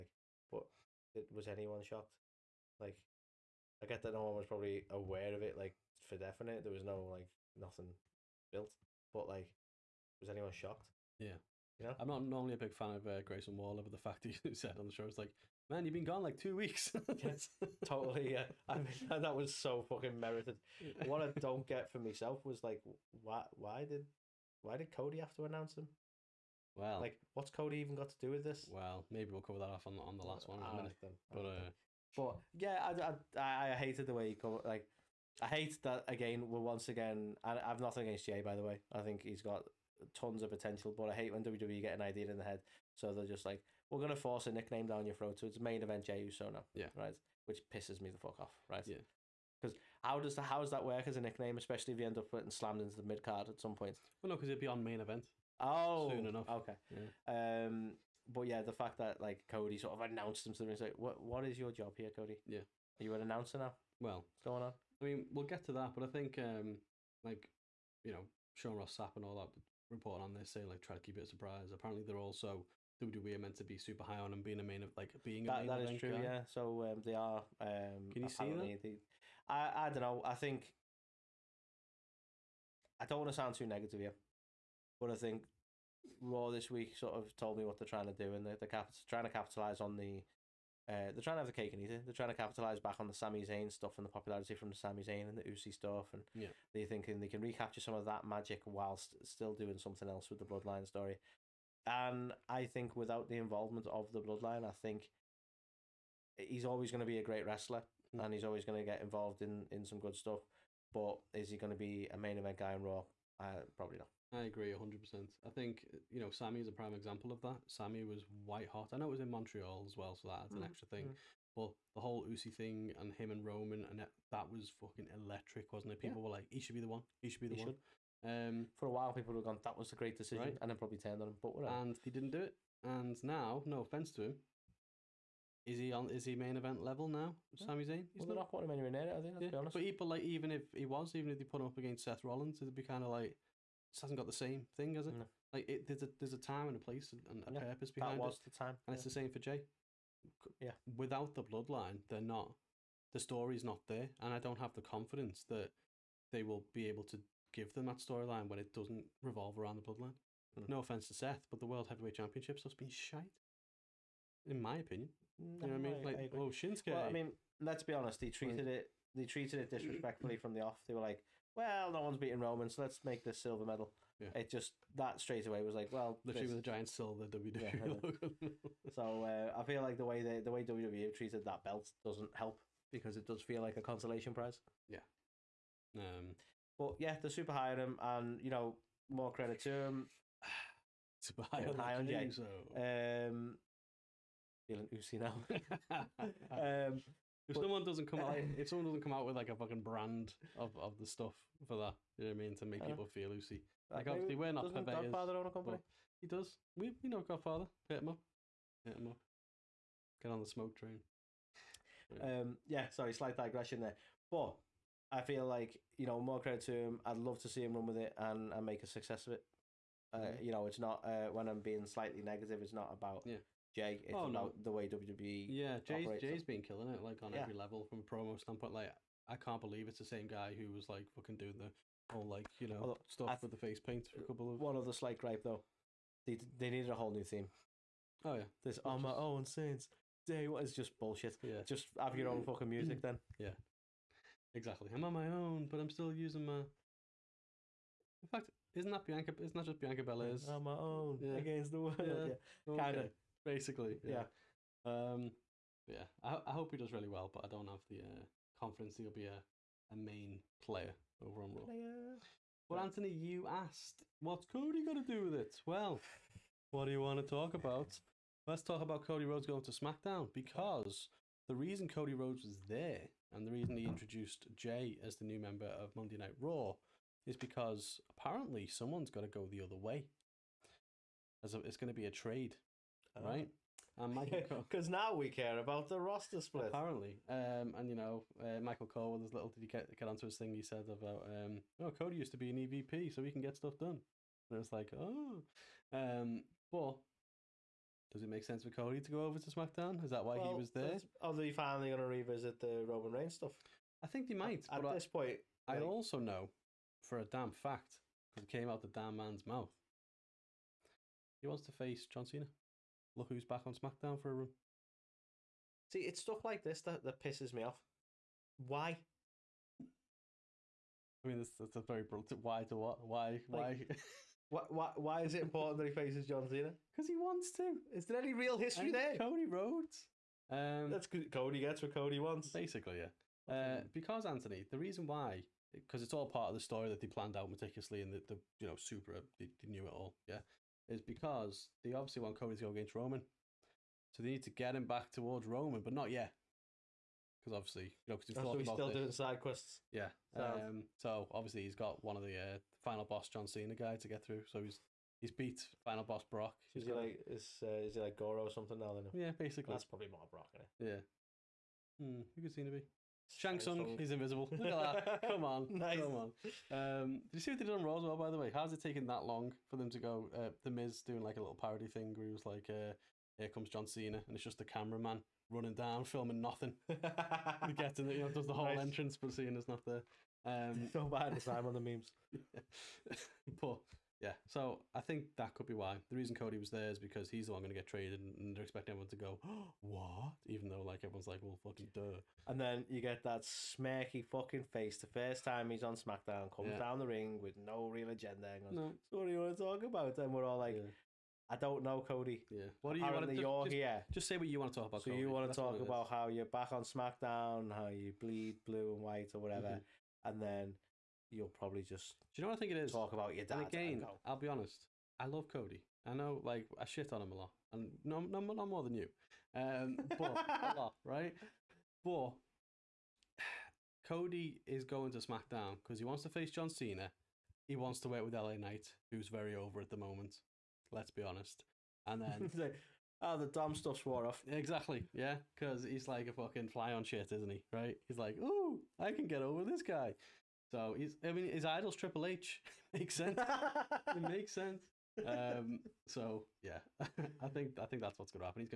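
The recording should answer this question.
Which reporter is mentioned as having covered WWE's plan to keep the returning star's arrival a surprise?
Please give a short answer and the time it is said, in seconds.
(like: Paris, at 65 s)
Sean Ross Sapp, at 68 s.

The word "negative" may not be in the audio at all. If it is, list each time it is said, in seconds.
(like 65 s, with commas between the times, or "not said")
83 s, 222 s.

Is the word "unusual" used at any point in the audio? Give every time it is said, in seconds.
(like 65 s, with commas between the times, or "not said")
not said.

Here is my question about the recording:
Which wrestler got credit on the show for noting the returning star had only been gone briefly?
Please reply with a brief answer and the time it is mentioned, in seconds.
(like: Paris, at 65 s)
Grayson Waller, at 13 s.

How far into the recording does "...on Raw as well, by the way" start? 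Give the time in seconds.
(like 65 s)
367 s.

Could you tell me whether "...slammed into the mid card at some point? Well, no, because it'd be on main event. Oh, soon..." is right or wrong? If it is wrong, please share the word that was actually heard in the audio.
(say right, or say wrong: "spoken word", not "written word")
right.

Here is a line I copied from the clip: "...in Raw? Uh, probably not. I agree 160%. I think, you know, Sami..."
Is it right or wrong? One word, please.
wrong.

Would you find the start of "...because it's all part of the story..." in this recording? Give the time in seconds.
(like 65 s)
335 s.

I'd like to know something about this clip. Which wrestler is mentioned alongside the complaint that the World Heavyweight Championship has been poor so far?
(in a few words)
Shinsuke.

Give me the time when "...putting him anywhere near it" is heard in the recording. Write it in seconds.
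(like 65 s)
138 s.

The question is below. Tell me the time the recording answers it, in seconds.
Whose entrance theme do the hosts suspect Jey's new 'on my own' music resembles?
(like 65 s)
249 s.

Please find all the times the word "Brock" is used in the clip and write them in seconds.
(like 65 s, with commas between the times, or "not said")
356 s, 360 s.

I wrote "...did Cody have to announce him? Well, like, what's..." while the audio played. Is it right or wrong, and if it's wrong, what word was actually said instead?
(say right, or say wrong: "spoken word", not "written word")
right.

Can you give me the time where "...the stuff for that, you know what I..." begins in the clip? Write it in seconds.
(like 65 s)
200 s.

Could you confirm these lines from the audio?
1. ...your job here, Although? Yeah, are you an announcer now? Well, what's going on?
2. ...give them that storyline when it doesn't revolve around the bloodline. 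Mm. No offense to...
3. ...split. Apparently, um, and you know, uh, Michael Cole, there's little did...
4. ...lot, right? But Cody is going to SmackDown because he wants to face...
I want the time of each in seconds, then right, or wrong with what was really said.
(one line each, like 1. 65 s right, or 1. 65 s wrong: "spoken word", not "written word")
1. 61 s wrong: "Cody", not "Although"
2. 157 s right
3. 286 s right
4. 420 s right.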